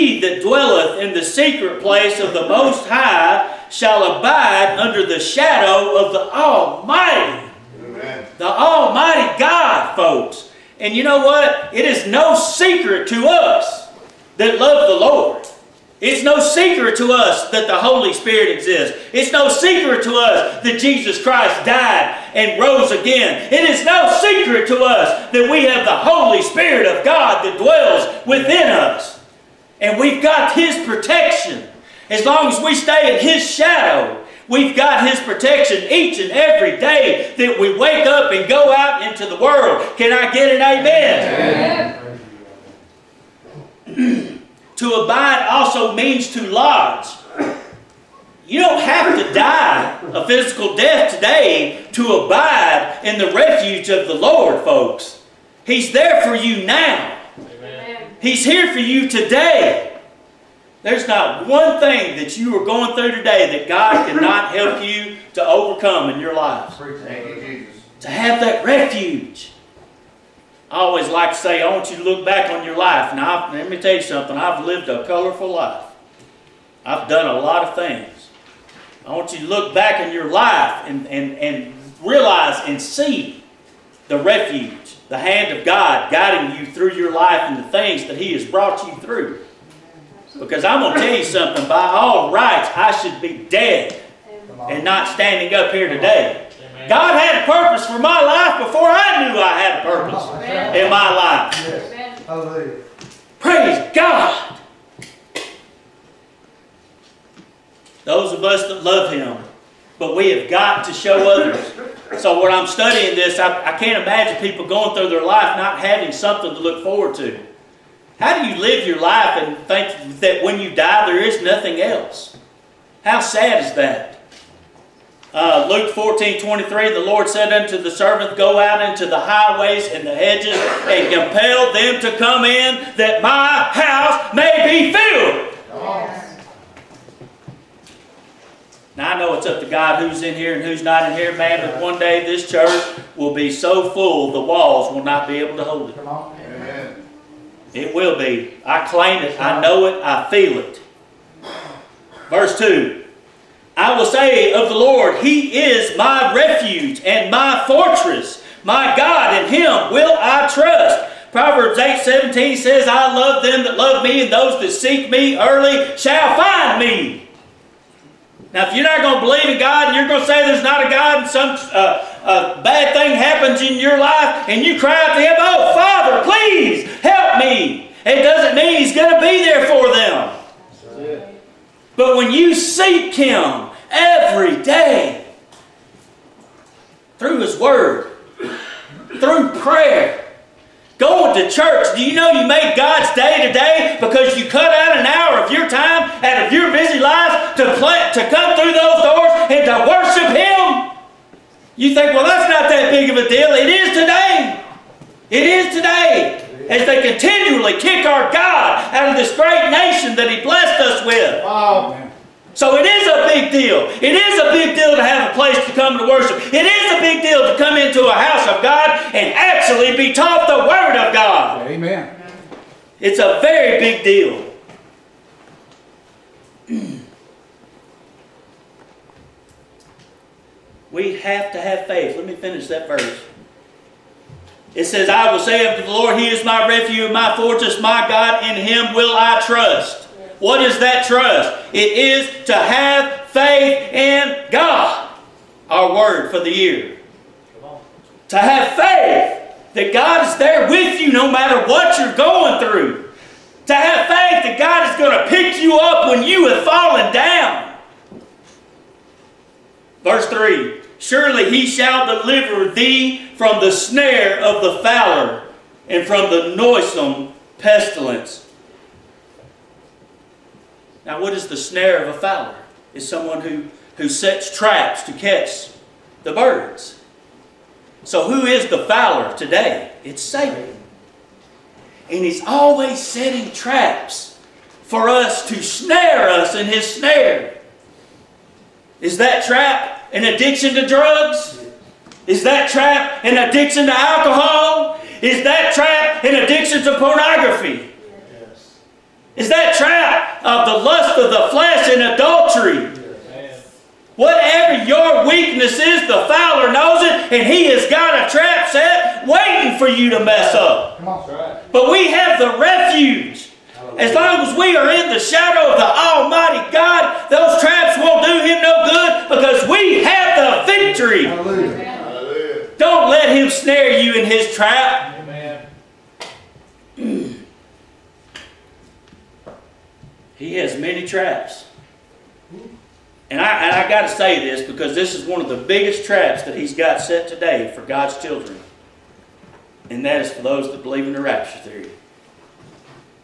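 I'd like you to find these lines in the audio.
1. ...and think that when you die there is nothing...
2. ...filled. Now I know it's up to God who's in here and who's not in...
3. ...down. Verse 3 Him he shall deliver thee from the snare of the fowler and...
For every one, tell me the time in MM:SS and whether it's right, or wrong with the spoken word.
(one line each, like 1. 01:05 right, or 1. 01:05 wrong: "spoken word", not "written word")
1. 01:59 right
2. 02:14 right
3. 04:17 wrong: "Surely", not "Him".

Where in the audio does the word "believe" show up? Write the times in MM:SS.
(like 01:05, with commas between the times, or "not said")
02:49, 05:40.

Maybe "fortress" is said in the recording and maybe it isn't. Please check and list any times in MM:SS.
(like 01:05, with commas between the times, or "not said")
02:37, 03:57.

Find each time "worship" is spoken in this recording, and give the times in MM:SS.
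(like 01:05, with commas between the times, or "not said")
03:19, 03:36.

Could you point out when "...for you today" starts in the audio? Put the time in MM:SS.
00:58.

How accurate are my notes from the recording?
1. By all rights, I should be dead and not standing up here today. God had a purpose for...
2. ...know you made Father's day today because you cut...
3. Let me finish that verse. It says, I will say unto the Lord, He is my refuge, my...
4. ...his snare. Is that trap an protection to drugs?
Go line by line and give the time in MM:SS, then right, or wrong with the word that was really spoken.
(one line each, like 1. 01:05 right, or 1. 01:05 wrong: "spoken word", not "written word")
1. 01:31 right
2. 03:12 wrong: "God", not "Father"
3. 03:52 right
4. 04:46 wrong: "addiction", not "protection".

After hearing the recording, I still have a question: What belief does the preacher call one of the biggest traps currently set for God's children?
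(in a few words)
the rapture theory.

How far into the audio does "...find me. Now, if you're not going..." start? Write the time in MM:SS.
02:46.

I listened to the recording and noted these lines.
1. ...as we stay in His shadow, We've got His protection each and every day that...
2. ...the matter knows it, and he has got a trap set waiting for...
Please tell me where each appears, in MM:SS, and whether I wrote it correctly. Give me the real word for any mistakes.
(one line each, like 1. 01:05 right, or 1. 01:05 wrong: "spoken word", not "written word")
1. 00:32 right
2. 05:06 wrong: "fowler", not "matter".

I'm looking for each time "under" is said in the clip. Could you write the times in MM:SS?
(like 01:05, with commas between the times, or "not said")
00:04.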